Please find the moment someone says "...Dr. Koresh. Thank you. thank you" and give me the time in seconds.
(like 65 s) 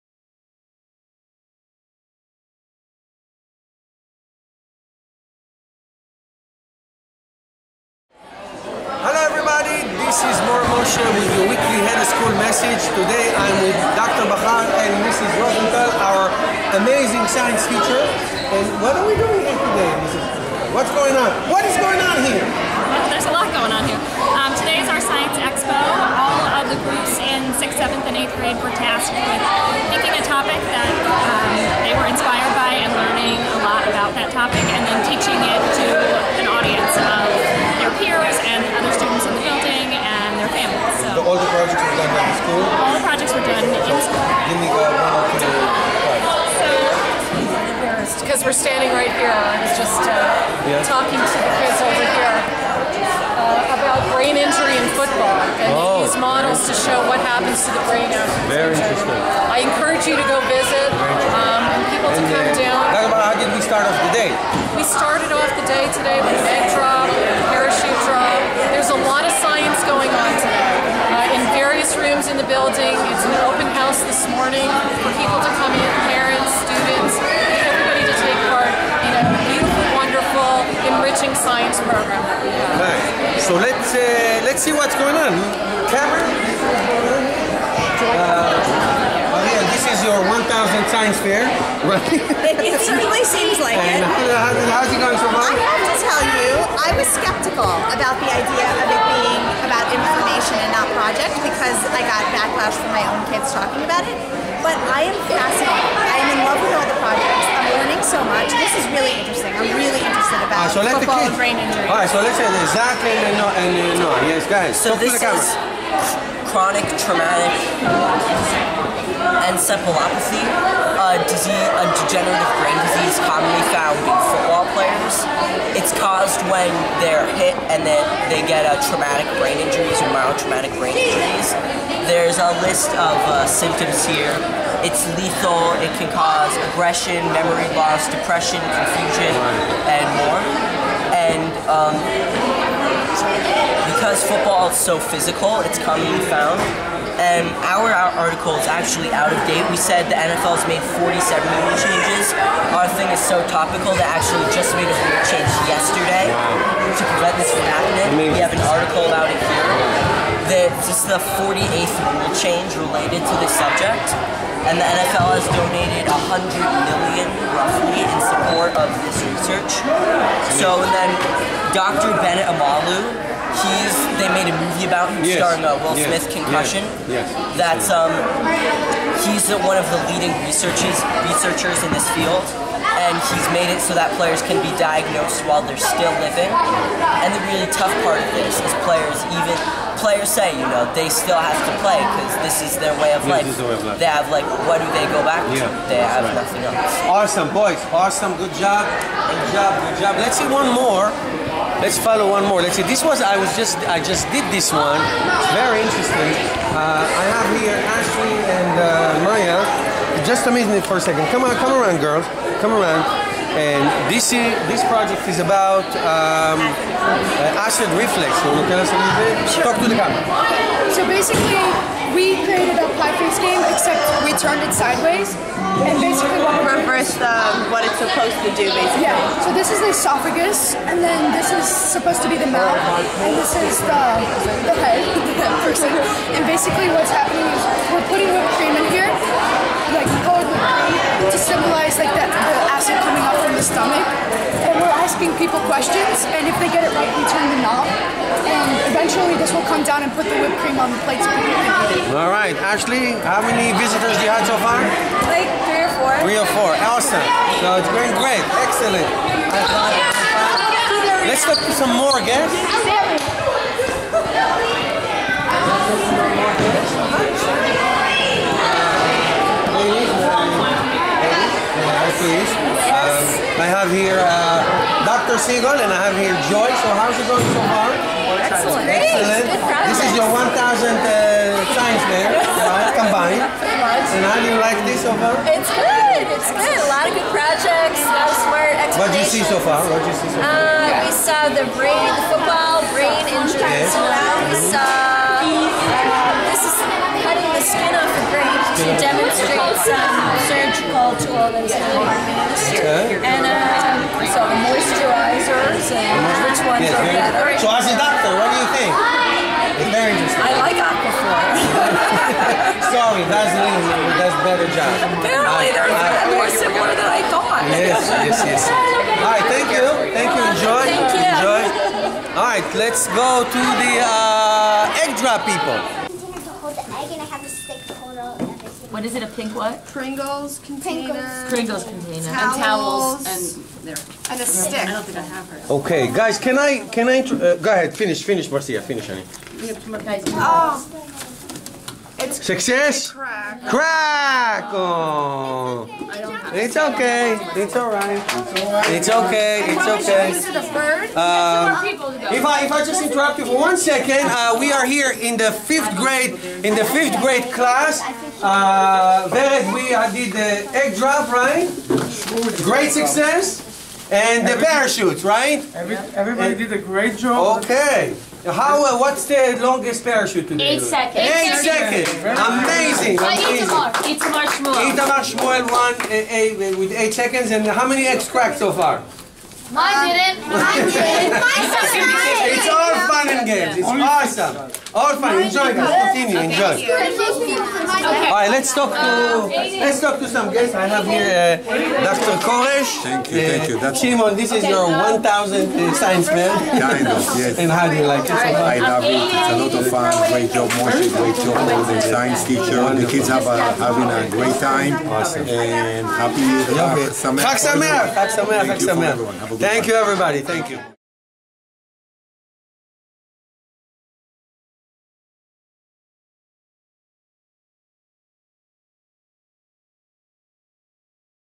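392 s.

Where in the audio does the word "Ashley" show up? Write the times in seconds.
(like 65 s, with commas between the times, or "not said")
207 s, 252 s.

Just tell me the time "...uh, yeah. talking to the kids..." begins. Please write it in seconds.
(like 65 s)
50 s.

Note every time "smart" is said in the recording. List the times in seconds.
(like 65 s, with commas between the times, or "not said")
288 s.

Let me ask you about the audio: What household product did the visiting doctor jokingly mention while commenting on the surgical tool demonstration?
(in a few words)
aquaphor.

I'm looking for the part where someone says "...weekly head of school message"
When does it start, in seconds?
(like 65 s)
11 s.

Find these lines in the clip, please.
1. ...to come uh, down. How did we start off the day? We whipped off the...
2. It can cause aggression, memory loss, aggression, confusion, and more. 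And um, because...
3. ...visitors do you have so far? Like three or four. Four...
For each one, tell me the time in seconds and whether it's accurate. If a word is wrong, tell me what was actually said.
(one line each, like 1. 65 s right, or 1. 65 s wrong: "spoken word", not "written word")
1. 62 s wrong: "started", not "whipped"
2. 135 s wrong: "depression", not "aggression"
3. 253 s wrong: "Three", not "Four".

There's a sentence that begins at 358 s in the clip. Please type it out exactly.
Uh, we did the egg drop, right?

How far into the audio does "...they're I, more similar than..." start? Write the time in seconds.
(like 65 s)
315 s.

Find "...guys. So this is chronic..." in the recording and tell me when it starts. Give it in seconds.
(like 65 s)
114 s.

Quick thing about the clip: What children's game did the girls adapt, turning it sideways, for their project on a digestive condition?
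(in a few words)
pie face.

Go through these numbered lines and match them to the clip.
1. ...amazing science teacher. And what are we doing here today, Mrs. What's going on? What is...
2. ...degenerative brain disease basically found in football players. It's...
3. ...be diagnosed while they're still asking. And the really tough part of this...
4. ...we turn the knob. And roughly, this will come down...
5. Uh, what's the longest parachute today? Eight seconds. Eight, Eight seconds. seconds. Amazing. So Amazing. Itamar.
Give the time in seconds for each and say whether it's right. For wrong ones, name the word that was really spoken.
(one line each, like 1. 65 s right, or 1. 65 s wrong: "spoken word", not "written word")
1. 16 s right
2. 121 s wrong: "commonly", not "basically"
3. 184 s wrong: "living", not "asking"
4. 247 s wrong: "eventually", not "roughly"
5. 368 s right.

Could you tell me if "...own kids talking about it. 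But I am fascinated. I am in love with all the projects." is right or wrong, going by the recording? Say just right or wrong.
right.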